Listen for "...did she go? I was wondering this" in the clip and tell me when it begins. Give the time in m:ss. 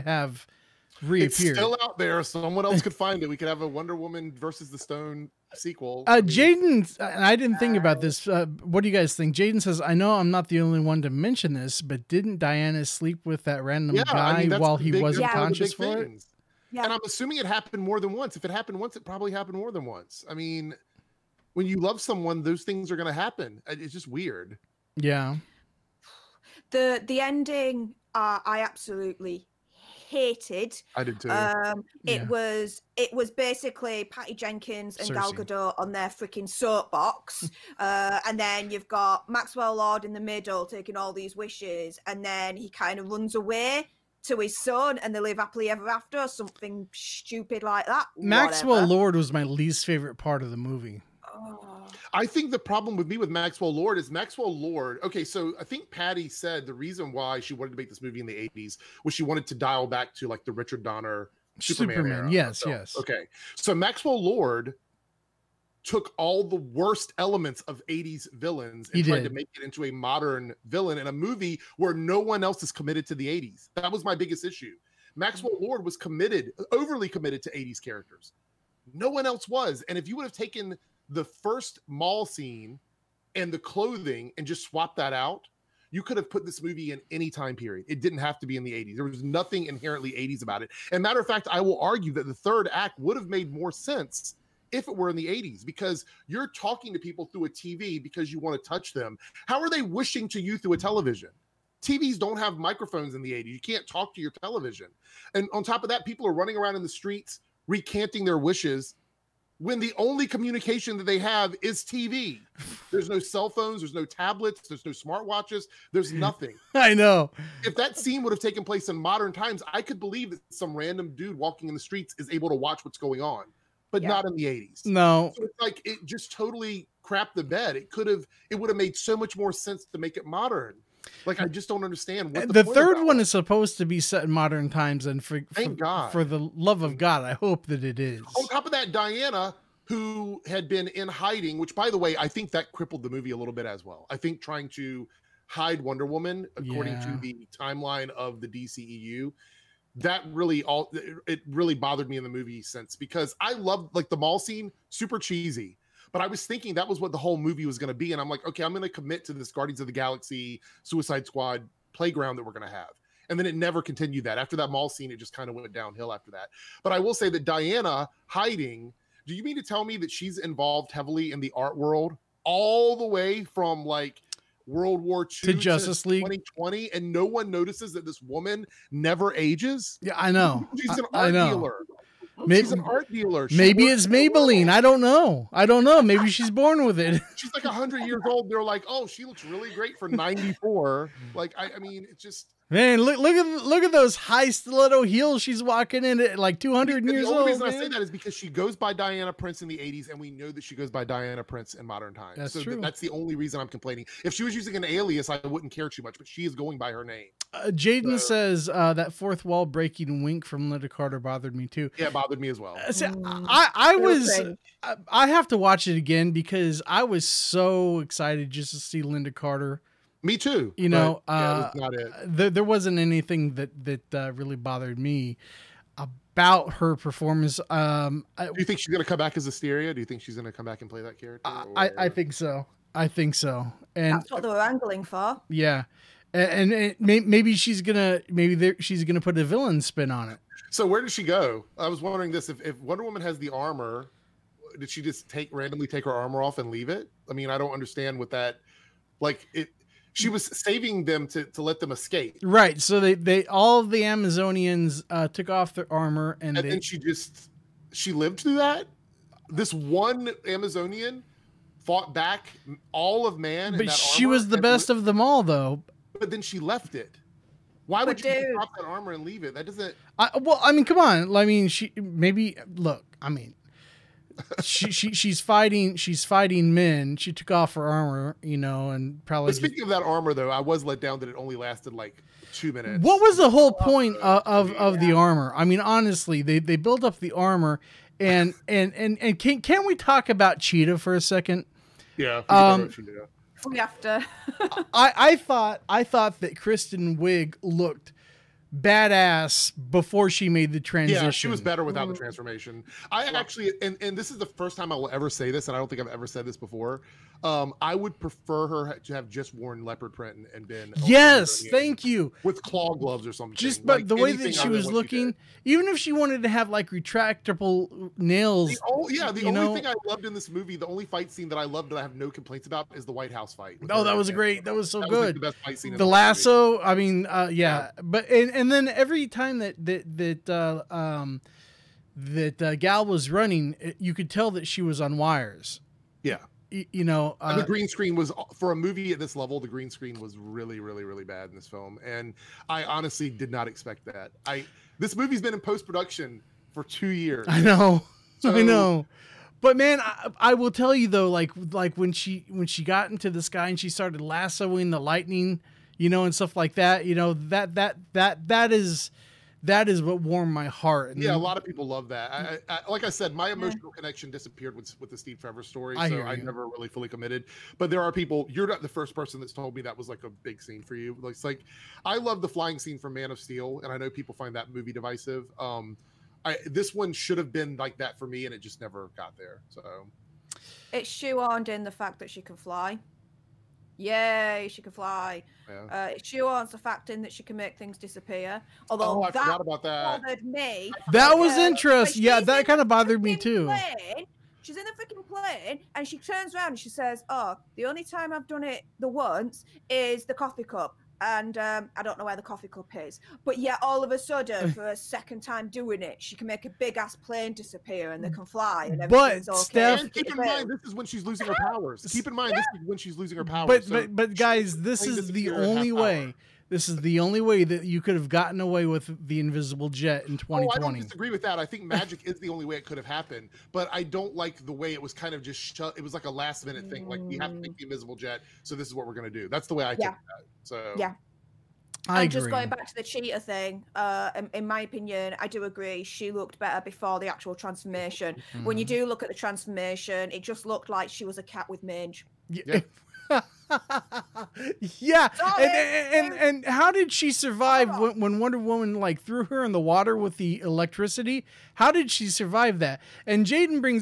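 4:01.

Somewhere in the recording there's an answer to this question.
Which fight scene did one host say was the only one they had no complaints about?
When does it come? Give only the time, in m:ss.
5:23.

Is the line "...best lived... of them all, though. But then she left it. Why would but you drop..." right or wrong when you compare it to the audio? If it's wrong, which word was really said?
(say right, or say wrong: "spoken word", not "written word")
right.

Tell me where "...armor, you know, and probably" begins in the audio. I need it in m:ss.
4:37.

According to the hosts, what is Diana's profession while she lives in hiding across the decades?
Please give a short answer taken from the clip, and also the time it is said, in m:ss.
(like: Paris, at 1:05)
Art dealer, at 3:02.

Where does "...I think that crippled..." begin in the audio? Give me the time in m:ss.
2:22.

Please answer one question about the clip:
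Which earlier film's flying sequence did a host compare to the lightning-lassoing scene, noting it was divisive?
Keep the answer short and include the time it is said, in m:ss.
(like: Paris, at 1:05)
Man of Steel, at 6:13.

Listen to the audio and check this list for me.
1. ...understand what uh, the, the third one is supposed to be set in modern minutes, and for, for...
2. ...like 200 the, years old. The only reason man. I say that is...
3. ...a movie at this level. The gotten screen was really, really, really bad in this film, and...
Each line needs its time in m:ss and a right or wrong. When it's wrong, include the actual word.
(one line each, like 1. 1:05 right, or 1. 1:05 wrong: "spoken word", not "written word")
1. 2:11 wrong: "times", not "minutes"
2. 3:16 right
3. 5:38 wrong: "green", not "gotten".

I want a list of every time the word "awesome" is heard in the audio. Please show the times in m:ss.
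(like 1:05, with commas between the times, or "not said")
not said.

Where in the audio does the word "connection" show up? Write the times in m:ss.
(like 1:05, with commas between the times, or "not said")
6:03.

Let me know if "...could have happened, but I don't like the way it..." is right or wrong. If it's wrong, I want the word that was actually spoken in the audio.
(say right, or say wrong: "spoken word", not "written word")
right.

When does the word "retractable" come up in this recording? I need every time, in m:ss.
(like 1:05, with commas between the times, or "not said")
5:16.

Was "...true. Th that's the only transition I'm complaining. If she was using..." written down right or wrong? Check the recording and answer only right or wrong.
wrong.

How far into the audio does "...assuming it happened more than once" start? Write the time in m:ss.
0:17.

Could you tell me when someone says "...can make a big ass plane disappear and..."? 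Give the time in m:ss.
6:46.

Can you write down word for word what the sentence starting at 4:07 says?
I mean, I don't understand what that.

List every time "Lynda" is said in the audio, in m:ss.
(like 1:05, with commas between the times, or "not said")
3:30, 3:39.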